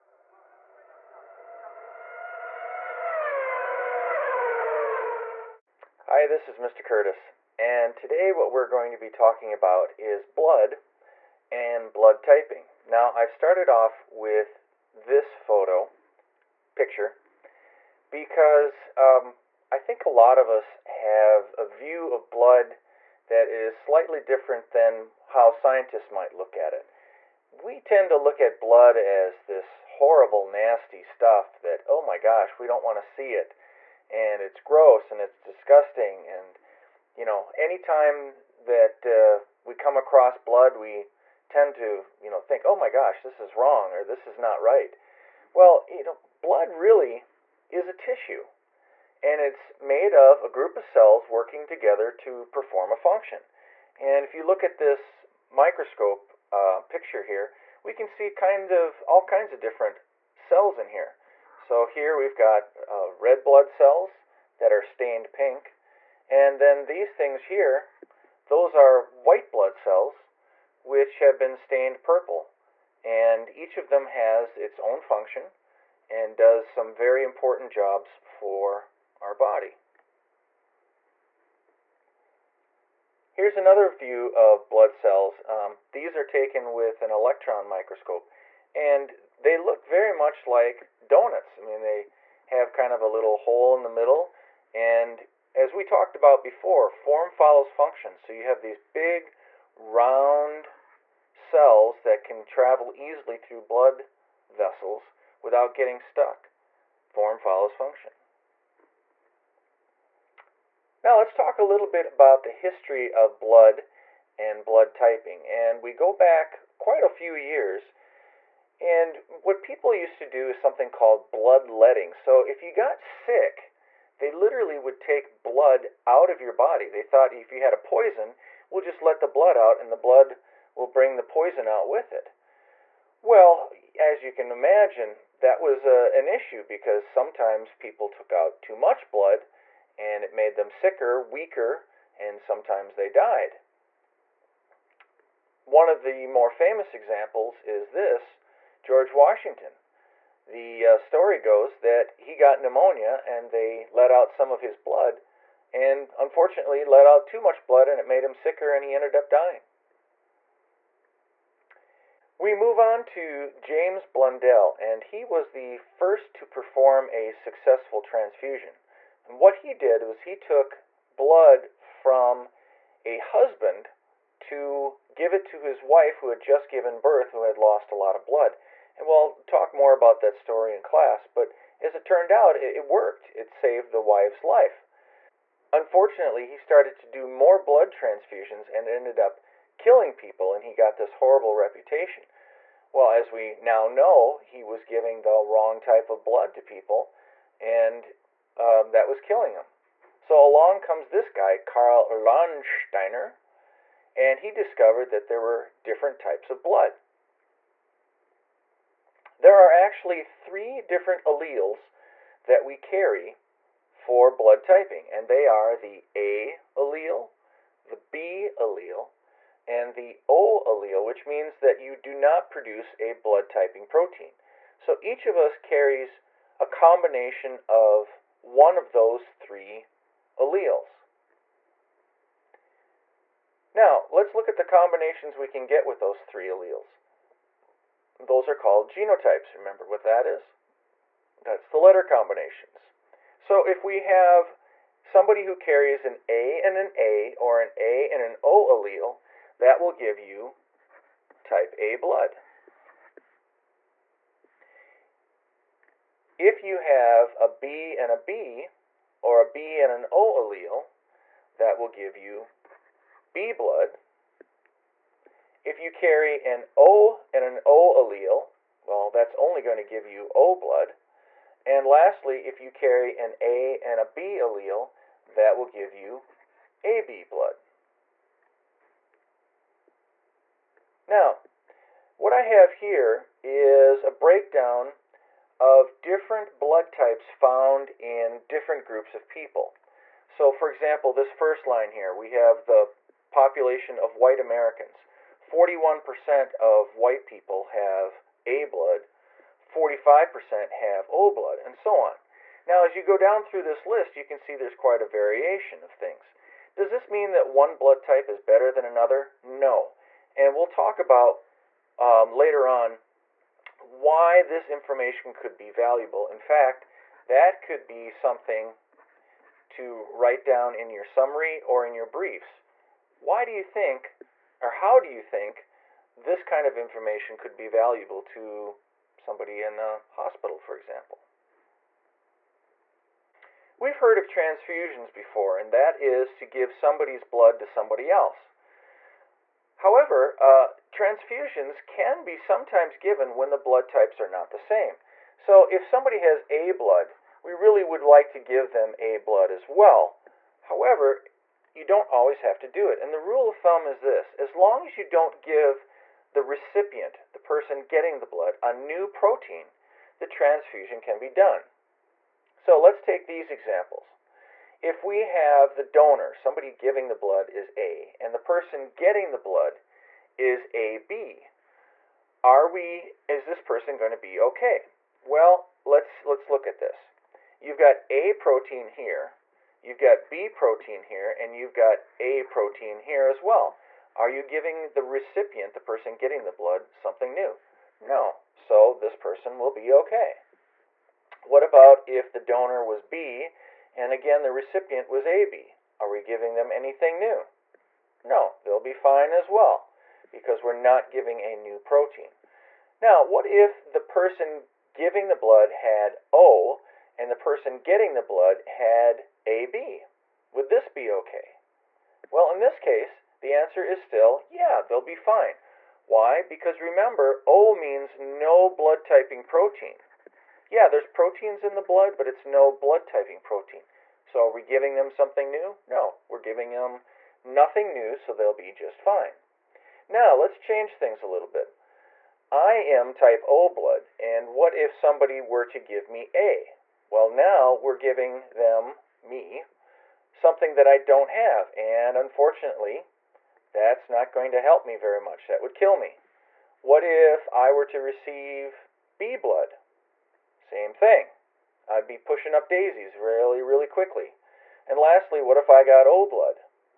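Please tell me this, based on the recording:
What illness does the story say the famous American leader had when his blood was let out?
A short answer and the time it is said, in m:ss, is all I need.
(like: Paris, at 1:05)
Pneumonia, at 2:32.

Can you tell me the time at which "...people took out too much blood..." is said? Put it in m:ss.
2:17.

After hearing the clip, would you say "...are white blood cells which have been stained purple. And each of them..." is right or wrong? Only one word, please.
right.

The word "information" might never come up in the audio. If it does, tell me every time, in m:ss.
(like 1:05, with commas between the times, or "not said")
5:14, 5:26.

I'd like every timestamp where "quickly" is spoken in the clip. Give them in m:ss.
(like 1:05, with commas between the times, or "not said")
7:33.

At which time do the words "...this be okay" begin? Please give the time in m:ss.
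6:50.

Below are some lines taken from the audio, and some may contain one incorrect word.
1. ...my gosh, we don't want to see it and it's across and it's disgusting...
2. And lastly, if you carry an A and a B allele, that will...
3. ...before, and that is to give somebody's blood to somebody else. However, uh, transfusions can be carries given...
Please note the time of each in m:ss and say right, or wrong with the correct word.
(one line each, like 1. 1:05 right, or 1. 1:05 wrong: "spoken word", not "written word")
1. 0:32 wrong: "gross", not "across"
2. 4:31 right
3. 5:35 wrong: "sometimes", not "carries".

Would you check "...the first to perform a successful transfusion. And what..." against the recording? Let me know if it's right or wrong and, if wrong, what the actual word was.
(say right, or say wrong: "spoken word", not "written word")
right.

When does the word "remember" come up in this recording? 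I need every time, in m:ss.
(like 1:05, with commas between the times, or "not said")
3:59, 6:56.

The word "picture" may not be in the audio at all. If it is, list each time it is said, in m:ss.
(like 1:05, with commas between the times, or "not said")
0:16, 0:56.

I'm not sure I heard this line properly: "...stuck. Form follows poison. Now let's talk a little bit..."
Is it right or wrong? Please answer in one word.
wrong.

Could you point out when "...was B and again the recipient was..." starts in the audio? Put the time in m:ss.
6:32.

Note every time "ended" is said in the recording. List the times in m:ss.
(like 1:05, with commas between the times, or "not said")
2:38, 3:08.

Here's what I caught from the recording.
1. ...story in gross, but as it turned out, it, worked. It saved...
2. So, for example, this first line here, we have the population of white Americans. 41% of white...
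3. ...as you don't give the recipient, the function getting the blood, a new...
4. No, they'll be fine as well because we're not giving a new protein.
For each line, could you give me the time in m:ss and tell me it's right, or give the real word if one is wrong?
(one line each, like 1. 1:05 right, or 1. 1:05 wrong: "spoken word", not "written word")
1. 3:00 wrong: "class", not "gross"
2. 4:50 right
3. 5:54 wrong: "person", not "function"
4. 6:38 right.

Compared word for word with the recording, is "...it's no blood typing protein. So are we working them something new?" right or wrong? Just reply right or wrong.
wrong.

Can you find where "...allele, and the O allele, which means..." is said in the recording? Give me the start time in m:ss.
3:38.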